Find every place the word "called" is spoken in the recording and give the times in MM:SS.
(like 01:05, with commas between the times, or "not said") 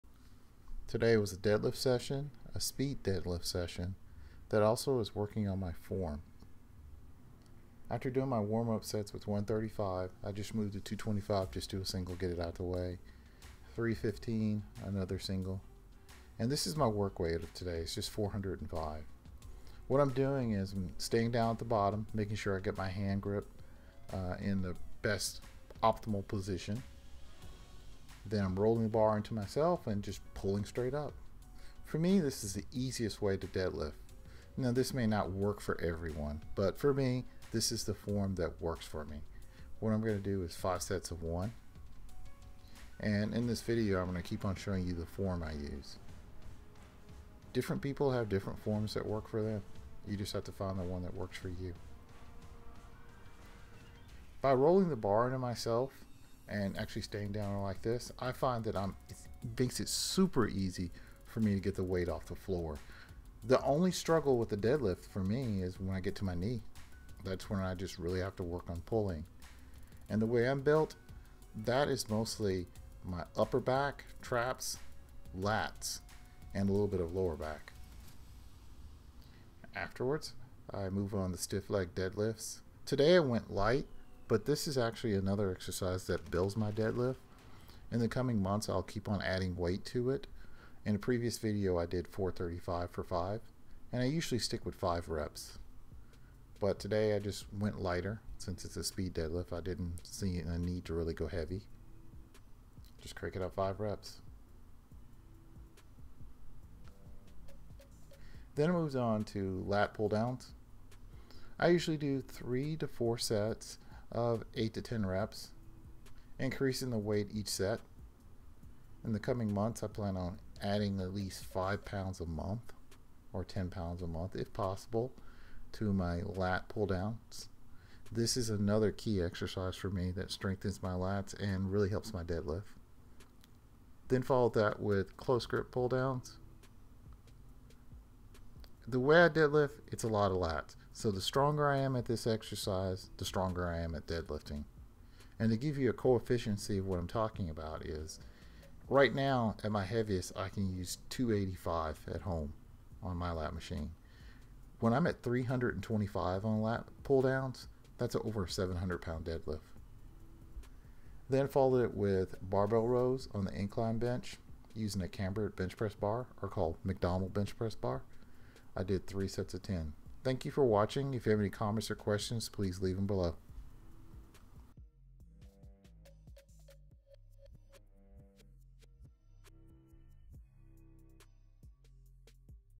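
02:46.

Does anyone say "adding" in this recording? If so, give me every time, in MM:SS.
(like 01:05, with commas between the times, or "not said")
01:29, 02:00.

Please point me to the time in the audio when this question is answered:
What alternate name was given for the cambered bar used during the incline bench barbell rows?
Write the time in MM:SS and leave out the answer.
02:46.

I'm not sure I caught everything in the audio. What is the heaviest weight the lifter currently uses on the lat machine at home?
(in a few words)
285.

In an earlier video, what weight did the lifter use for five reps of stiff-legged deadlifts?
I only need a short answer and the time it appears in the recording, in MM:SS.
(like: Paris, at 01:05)
435, at 01:32.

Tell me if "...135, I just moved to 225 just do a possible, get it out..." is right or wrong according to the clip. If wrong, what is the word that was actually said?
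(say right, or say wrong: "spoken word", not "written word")
wrong: "single", not "possible".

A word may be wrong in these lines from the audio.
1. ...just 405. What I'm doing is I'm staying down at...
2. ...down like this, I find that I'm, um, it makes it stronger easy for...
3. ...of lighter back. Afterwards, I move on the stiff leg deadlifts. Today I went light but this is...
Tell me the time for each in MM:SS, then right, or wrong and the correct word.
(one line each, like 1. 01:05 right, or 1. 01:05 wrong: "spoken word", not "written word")
1. 00:17 right
2. 00:57 wrong: "super", not "stronger"
3. 01:16 wrong: "lower", not "lighter".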